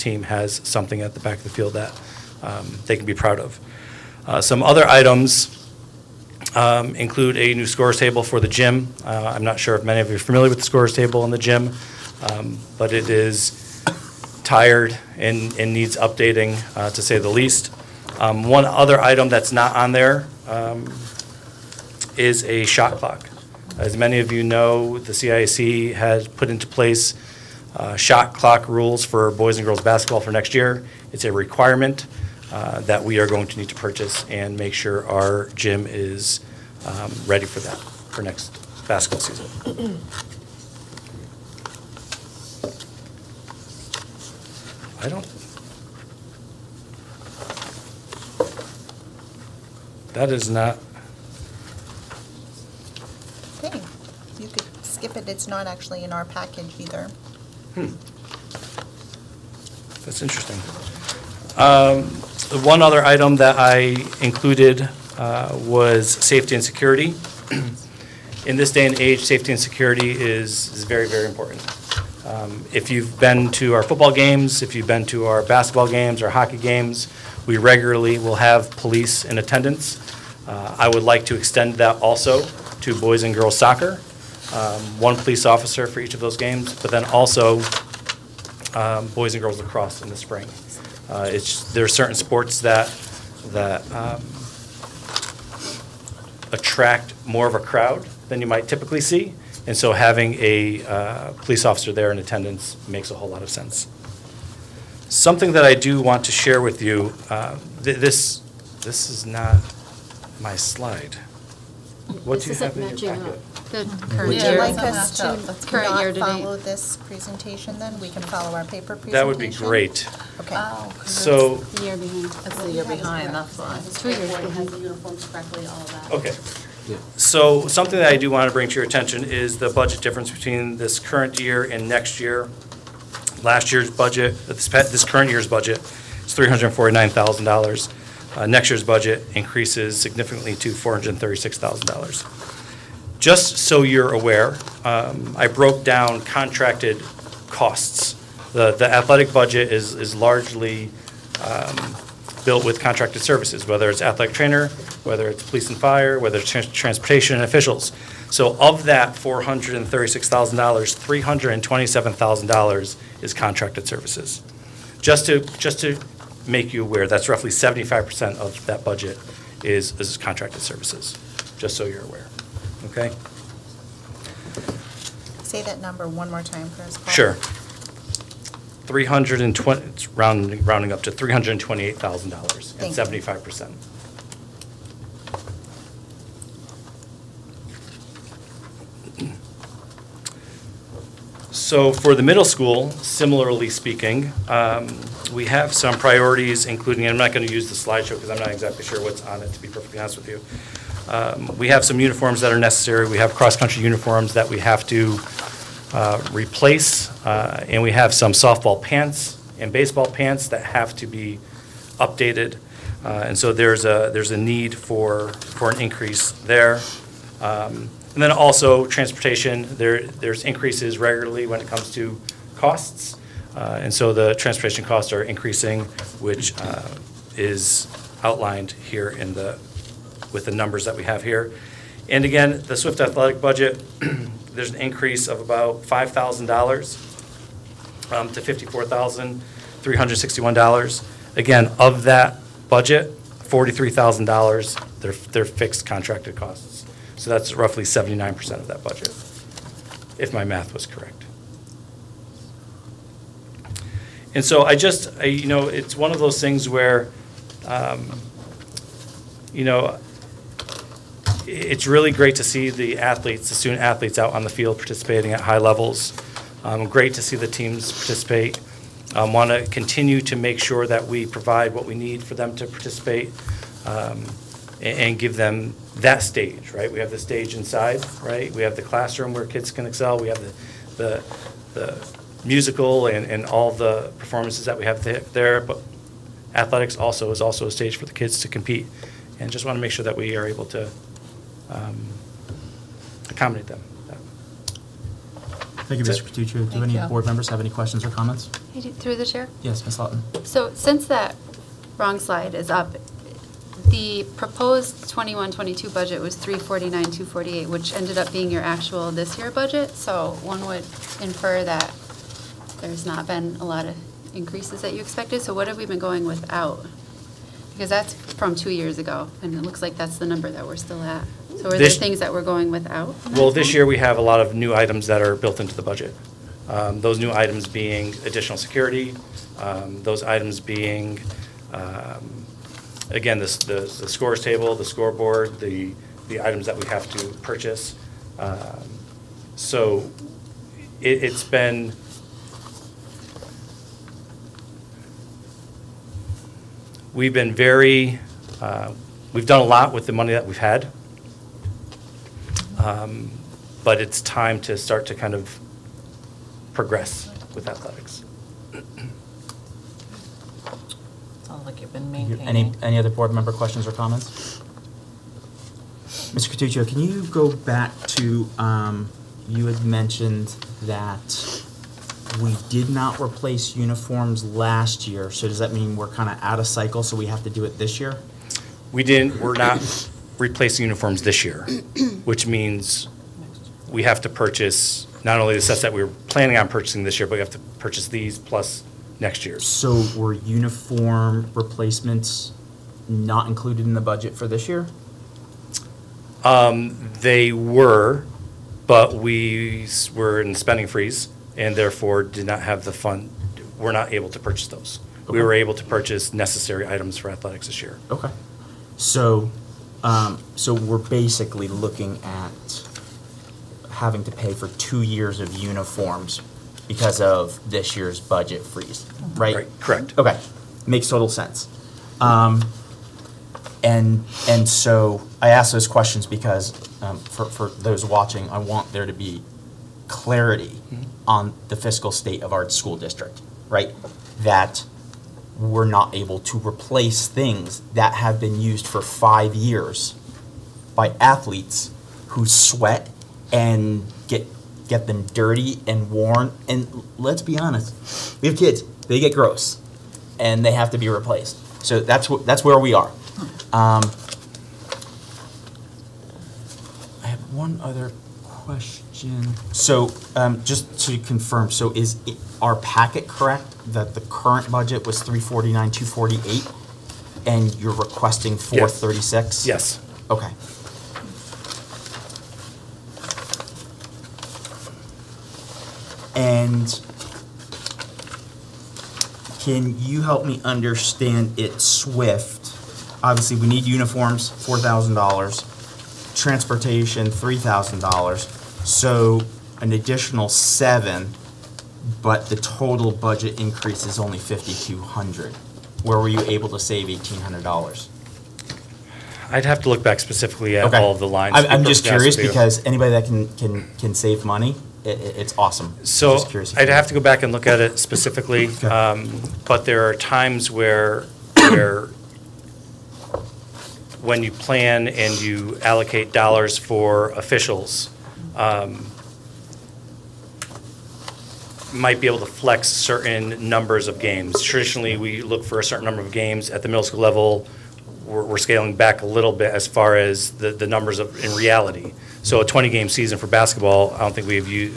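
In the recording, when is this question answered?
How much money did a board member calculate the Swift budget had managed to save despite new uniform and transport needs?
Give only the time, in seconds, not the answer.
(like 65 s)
497 s.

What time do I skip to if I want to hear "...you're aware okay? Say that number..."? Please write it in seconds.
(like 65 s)
171 s.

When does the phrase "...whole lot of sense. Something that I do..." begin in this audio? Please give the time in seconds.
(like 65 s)
103 s.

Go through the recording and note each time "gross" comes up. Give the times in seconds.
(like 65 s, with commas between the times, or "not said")
449 s.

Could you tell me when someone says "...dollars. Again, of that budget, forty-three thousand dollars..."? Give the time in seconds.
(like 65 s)
240 s.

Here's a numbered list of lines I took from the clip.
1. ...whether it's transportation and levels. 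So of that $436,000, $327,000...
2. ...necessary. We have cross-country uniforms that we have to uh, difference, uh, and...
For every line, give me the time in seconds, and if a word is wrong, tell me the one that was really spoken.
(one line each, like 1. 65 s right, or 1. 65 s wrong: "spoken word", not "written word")
1. 156 s wrong: "officials", not "levels"
2. 202 s wrong: "replace", not "difference".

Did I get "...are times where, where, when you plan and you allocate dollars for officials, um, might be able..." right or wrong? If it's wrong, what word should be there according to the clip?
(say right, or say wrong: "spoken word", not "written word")
right.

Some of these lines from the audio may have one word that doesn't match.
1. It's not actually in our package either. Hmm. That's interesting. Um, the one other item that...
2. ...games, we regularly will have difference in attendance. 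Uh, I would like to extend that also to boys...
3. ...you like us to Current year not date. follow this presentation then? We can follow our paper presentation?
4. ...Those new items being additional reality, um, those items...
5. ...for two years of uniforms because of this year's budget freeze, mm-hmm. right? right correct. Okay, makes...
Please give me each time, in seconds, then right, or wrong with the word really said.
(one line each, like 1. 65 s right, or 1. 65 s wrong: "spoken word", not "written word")
1. 55 s right
2. 76 s wrong: "police", not "difference"
3. 114 s right
4. 327 s wrong: "security", not "reality"
5. 414 s right.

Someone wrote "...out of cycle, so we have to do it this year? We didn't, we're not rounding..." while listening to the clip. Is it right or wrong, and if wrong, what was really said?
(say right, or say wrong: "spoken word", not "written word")
wrong: "replacing", not "rounding".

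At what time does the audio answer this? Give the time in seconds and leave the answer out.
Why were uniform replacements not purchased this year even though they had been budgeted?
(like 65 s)
400 s.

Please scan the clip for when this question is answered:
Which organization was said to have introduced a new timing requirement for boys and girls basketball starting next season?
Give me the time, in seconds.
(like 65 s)
25 s.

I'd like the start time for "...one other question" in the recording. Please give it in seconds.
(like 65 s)
457 s.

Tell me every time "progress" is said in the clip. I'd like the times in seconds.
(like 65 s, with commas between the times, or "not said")
356 s.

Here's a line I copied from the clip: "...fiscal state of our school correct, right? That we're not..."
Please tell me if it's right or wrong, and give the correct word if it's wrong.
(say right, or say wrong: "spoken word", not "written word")
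wrong: "district", not "correct".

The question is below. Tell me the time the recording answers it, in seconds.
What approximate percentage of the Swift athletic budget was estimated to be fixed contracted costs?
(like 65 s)
247 s.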